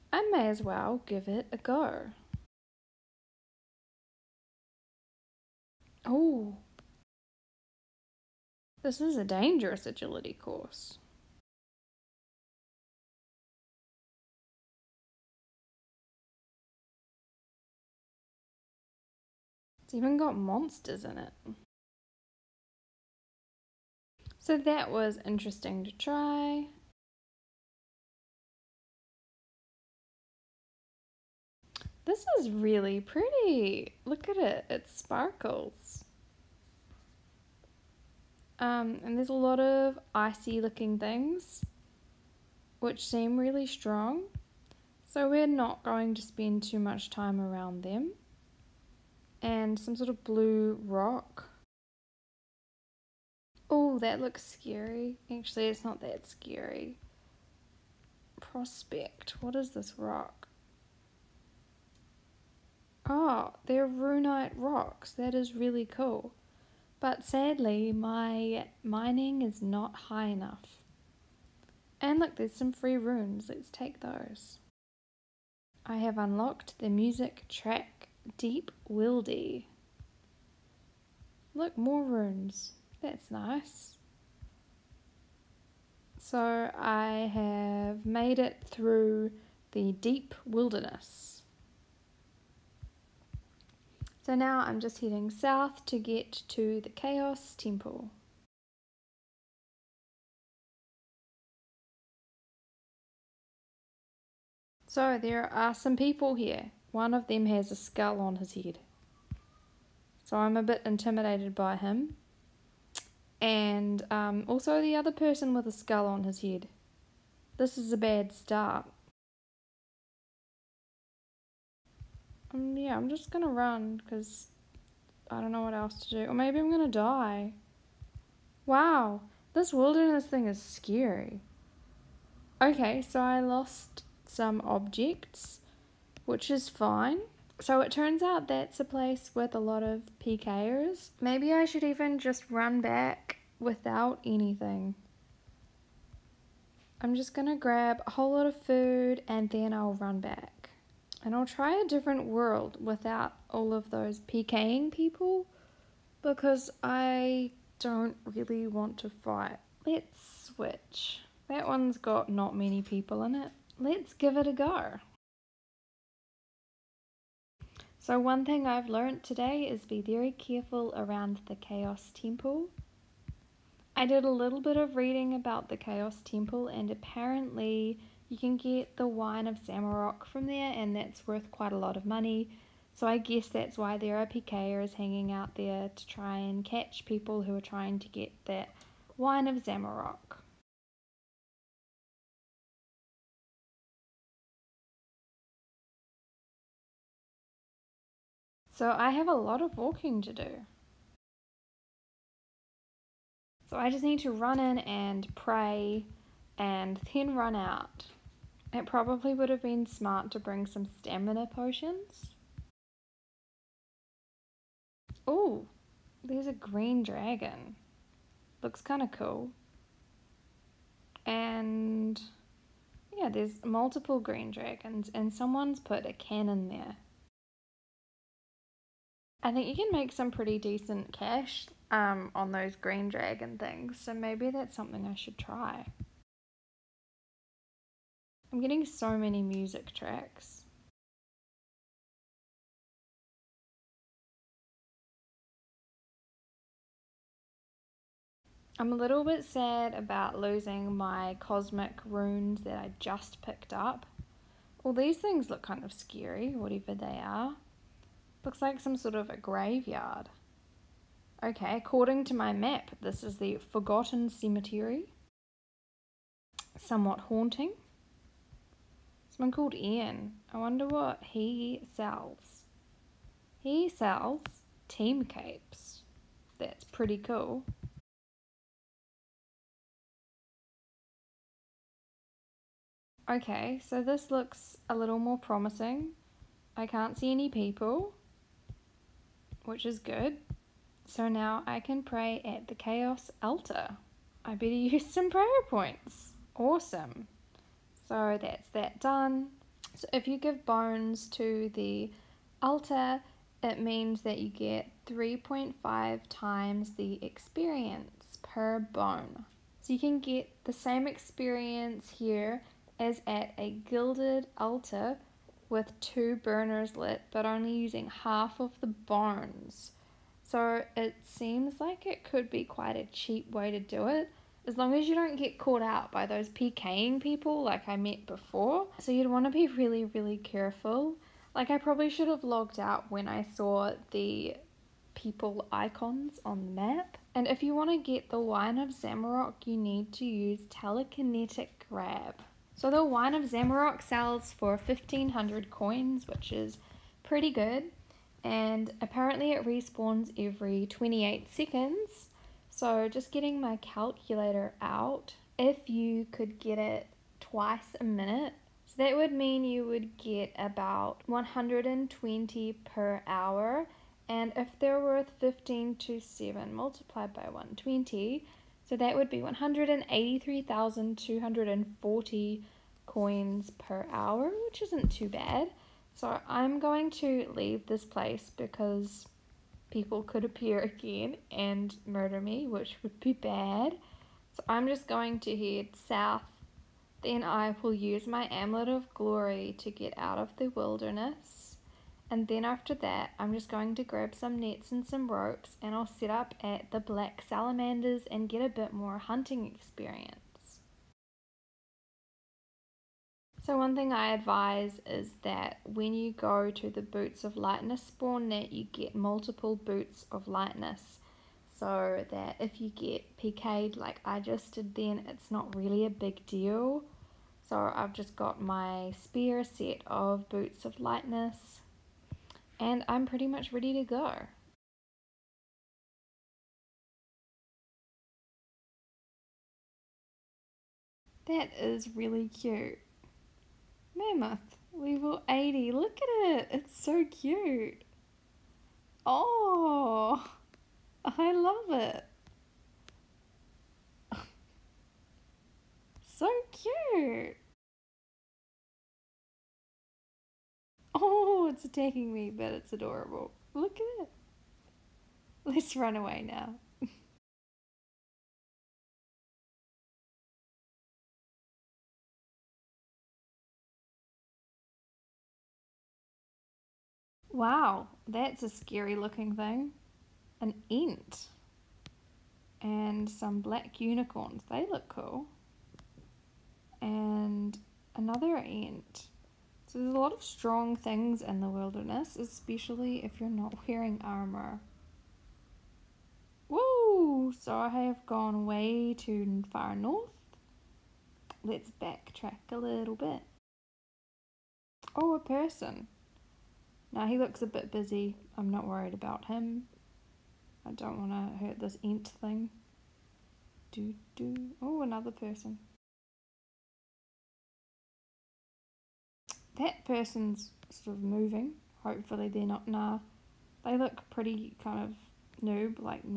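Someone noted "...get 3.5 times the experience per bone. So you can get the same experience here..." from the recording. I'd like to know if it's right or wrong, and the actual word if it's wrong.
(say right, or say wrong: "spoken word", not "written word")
right.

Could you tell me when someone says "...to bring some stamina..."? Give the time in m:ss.
3:30.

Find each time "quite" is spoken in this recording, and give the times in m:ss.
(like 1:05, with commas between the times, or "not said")
3:01, 5:22.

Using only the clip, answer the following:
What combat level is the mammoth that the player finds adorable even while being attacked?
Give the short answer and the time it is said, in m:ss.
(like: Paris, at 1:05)
80, at 7:14.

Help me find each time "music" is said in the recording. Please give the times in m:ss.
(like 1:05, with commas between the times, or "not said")
1:16, 3:59.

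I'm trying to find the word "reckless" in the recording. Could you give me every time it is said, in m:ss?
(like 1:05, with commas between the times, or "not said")
not said.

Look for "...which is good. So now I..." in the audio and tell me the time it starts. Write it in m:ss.
4:49.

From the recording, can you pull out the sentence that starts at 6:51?
So that if you get PK'd like I just did then, it's not really a big deal.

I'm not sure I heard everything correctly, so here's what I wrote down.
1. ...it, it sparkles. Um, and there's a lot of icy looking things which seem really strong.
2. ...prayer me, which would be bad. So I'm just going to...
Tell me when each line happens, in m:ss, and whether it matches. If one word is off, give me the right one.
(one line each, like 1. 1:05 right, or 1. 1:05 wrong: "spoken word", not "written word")
1. 0:34 right
2. 6:22 wrong: "murder", not "prayer".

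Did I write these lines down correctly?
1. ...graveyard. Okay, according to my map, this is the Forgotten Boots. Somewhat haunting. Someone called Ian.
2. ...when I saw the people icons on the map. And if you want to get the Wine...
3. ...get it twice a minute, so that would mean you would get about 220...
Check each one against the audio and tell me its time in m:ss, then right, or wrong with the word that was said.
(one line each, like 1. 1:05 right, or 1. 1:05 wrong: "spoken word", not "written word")
1. 4:19 wrong: "Cemetery", not "Boots"
2. 5:33 right
3. 5:56 wrong: "120", not "220".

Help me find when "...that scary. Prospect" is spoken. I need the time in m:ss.
0:56.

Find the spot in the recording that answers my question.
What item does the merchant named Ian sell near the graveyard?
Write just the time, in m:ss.
4:34.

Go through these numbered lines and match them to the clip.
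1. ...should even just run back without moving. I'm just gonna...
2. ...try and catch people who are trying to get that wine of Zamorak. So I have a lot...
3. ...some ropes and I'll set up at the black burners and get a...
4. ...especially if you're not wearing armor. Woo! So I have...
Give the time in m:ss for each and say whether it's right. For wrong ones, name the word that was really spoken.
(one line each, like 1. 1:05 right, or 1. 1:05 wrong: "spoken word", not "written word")
1. 2:21 wrong: "anything", not "moving"
2. 3:06 right
3. 6:35 wrong: "salamanders", not "burners"
4. 8:02 right.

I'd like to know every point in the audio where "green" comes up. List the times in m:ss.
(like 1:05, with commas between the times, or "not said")
3:36, 3:44, 3:52.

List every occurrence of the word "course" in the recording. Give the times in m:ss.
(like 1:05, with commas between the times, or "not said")
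0:10.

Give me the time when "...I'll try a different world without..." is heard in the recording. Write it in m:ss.
2:31.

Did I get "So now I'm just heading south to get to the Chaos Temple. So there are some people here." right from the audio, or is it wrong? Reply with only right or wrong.
right.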